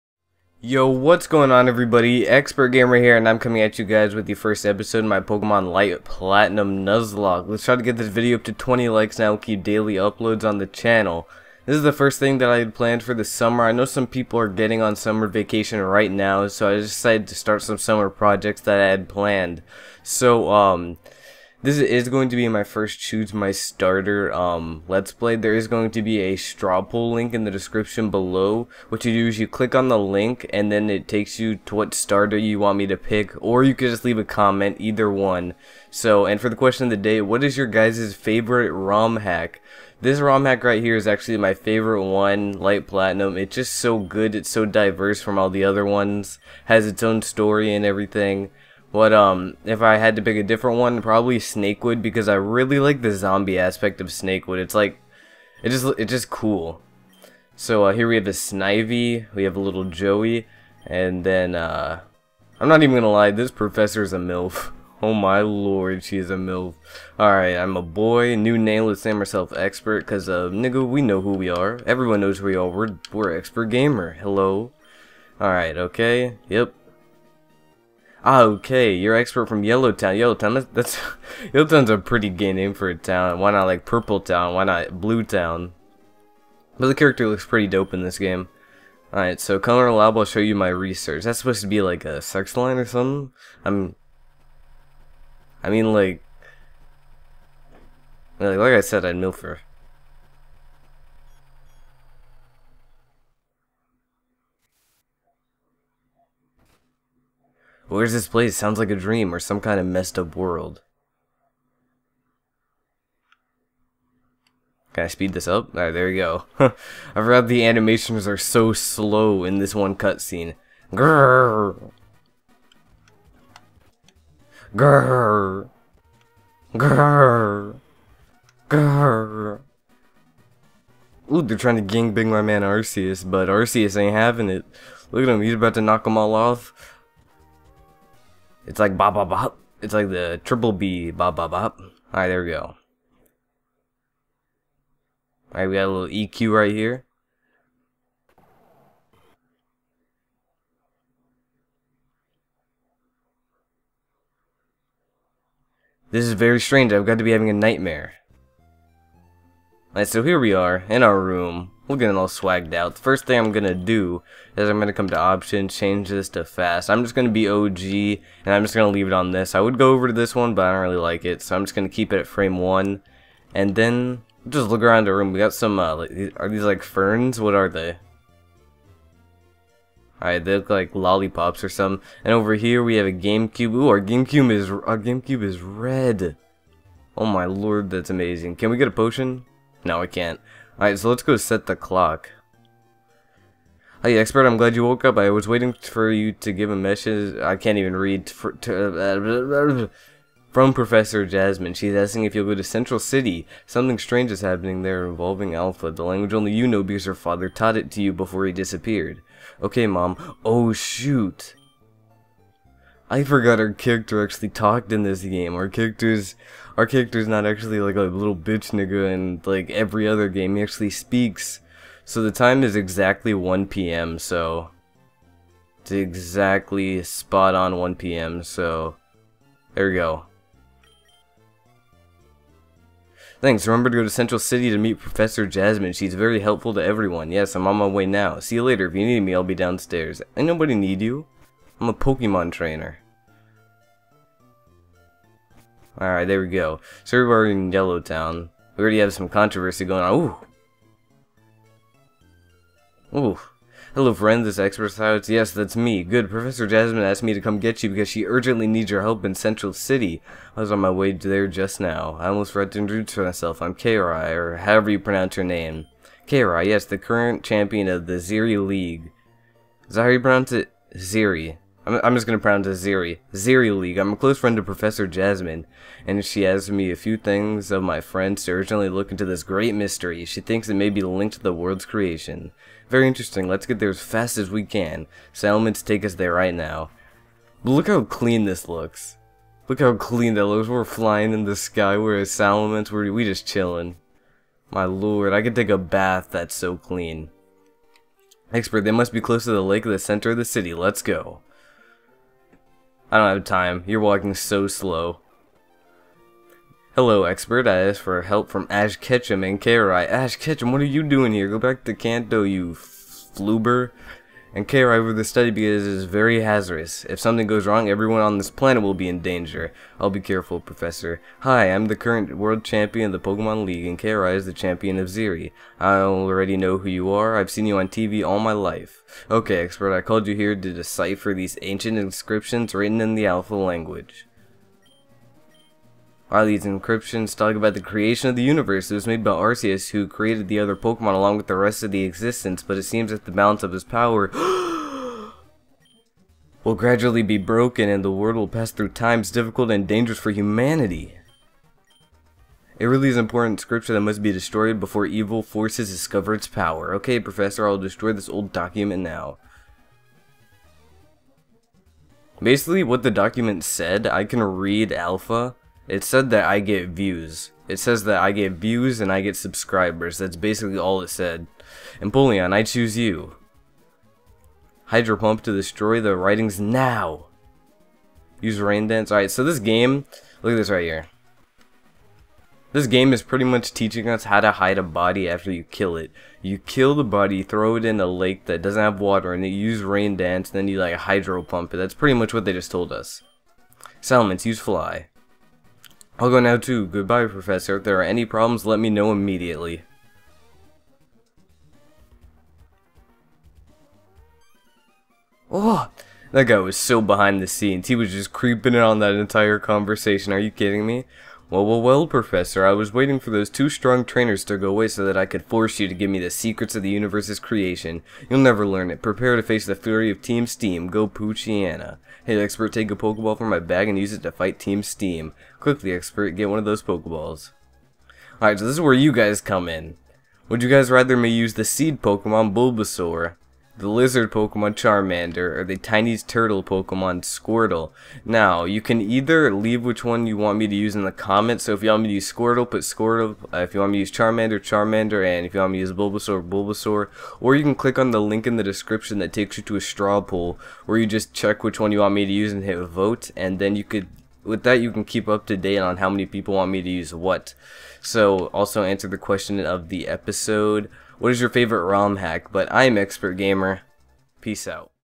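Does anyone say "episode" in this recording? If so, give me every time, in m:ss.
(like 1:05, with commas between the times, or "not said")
0:04, 7:40.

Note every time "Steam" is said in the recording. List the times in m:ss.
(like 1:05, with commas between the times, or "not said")
7:00, 7:04.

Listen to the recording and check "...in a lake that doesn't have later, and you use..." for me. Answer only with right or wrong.
wrong.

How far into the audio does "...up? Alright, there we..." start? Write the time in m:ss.
1:55.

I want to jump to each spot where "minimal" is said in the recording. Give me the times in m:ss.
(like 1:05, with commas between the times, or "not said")
not said.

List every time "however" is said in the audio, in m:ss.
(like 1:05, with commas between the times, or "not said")
4:24.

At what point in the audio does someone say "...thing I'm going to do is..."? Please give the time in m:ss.
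2:43.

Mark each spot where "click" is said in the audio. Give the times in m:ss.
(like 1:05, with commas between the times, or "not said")
0:29, 7:27.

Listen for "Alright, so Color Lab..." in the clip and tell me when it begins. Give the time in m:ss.
1:29.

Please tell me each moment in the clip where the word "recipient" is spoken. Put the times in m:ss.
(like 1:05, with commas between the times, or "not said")
not said.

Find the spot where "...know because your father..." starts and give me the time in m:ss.
3:26.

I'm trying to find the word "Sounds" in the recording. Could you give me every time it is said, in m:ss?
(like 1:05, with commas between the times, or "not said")
1:48.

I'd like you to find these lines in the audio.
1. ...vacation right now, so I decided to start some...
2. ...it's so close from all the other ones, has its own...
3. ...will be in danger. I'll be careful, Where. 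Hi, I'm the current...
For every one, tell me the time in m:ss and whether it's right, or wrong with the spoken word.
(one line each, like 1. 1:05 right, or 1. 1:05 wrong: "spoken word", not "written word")
1. 0:15 right
2. 0:44 wrong: "diverse", not "close"
3. 5:18 wrong: "Professor", not "Where".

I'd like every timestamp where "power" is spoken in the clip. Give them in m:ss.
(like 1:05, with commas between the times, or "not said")
5:43, 5:56.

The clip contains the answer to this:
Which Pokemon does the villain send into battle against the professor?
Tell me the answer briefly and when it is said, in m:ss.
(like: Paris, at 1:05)
Poochyena, at 7:01.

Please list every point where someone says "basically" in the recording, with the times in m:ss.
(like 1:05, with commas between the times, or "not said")
6:02, 6:10.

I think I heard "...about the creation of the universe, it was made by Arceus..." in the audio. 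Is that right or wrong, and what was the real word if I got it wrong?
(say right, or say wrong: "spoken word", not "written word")
right.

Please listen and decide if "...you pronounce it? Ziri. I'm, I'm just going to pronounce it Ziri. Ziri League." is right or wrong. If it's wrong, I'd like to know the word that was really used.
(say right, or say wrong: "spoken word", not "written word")
right.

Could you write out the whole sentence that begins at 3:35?
Our character's our character's not actually like a little bitch nigga in like every other game.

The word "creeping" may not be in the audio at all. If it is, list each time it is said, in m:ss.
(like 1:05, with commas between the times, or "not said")
6:48.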